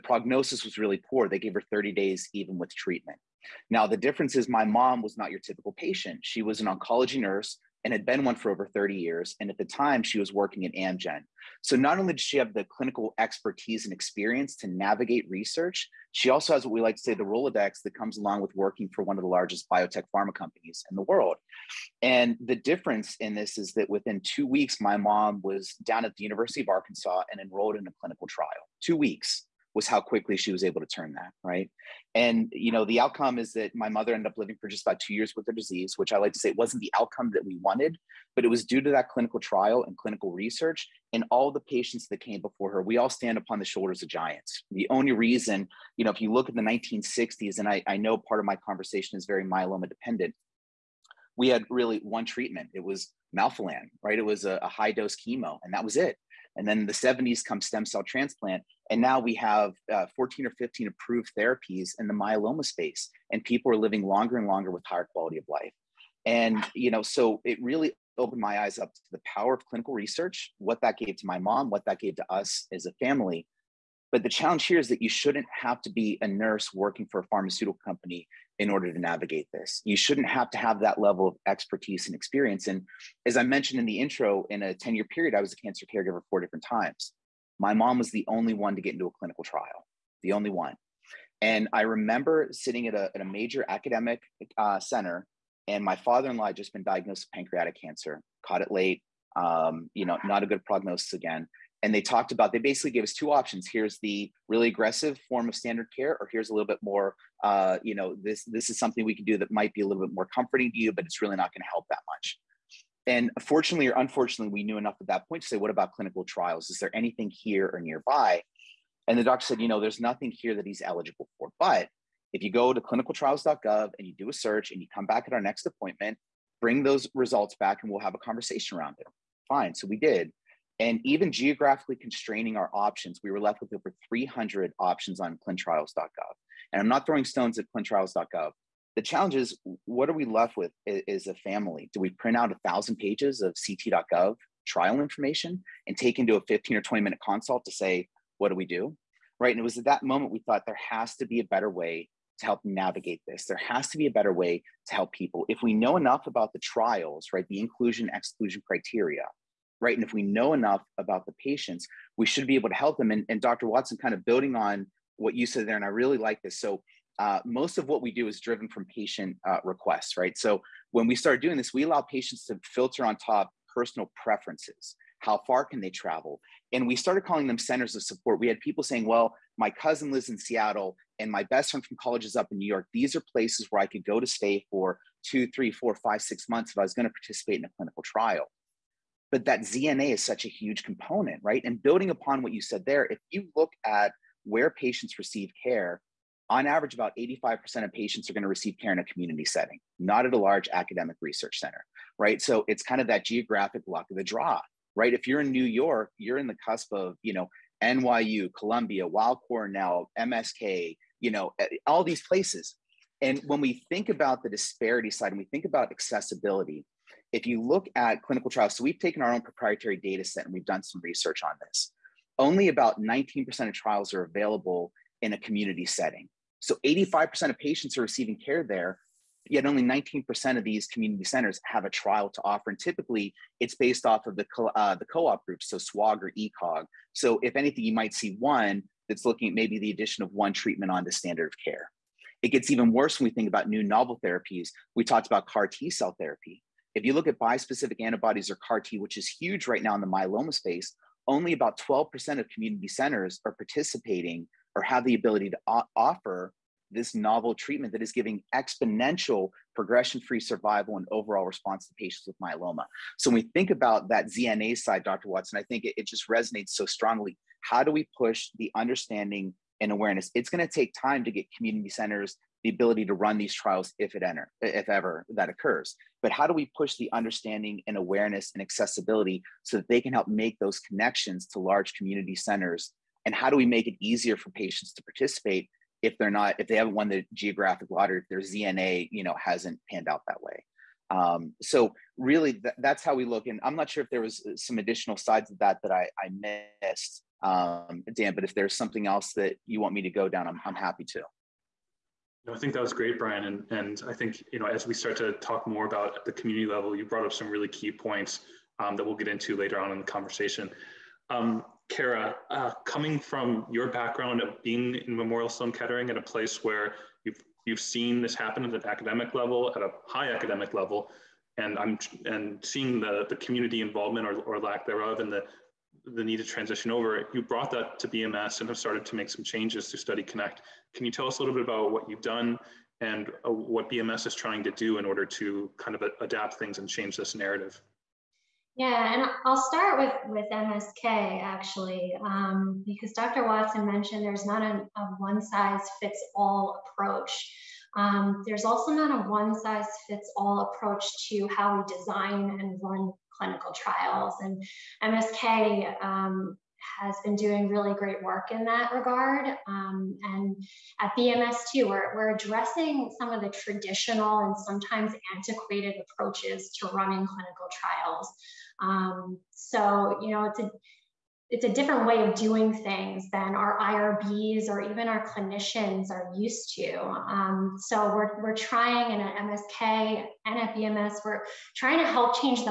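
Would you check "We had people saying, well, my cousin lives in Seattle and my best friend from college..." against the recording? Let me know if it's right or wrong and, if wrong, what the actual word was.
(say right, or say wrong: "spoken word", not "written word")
right.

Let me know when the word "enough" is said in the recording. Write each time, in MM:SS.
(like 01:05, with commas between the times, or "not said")
01:54, 02:35, 02:40.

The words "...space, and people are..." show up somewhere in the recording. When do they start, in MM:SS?
01:02.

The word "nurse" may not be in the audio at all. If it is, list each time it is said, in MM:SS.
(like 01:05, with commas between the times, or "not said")
00:07, 01:16.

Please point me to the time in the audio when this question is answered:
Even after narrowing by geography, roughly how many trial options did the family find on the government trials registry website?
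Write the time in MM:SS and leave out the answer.
02:13.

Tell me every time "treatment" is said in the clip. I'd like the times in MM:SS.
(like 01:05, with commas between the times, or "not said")
00:02, 00:52, 04:00, 04:17.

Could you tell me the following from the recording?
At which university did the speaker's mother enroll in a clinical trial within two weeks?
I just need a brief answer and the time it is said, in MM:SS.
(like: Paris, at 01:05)
University of Arkansas, at 00:26.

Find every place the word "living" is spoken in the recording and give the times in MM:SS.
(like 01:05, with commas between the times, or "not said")
00:34, 01:03.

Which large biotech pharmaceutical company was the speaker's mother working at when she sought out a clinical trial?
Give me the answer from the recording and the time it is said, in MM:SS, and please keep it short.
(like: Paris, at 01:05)
Amgen, at 00:10.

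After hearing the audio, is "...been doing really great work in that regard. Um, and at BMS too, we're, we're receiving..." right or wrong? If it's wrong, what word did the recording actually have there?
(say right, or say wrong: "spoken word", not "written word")
wrong: "addressing", not "receiving".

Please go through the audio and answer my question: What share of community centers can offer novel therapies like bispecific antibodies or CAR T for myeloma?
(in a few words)
12%.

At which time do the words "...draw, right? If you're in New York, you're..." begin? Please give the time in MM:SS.
03:24.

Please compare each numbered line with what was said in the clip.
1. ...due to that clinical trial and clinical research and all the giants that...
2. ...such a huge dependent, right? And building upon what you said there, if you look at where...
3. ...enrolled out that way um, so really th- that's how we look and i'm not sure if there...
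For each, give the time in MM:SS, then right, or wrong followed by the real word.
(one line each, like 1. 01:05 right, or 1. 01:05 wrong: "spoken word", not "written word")
1. 00:38 wrong: "patients", not "giants"
2. 03:10 wrong: "component", not "dependent"
3. 04:49 wrong: "panned", not "enrolled".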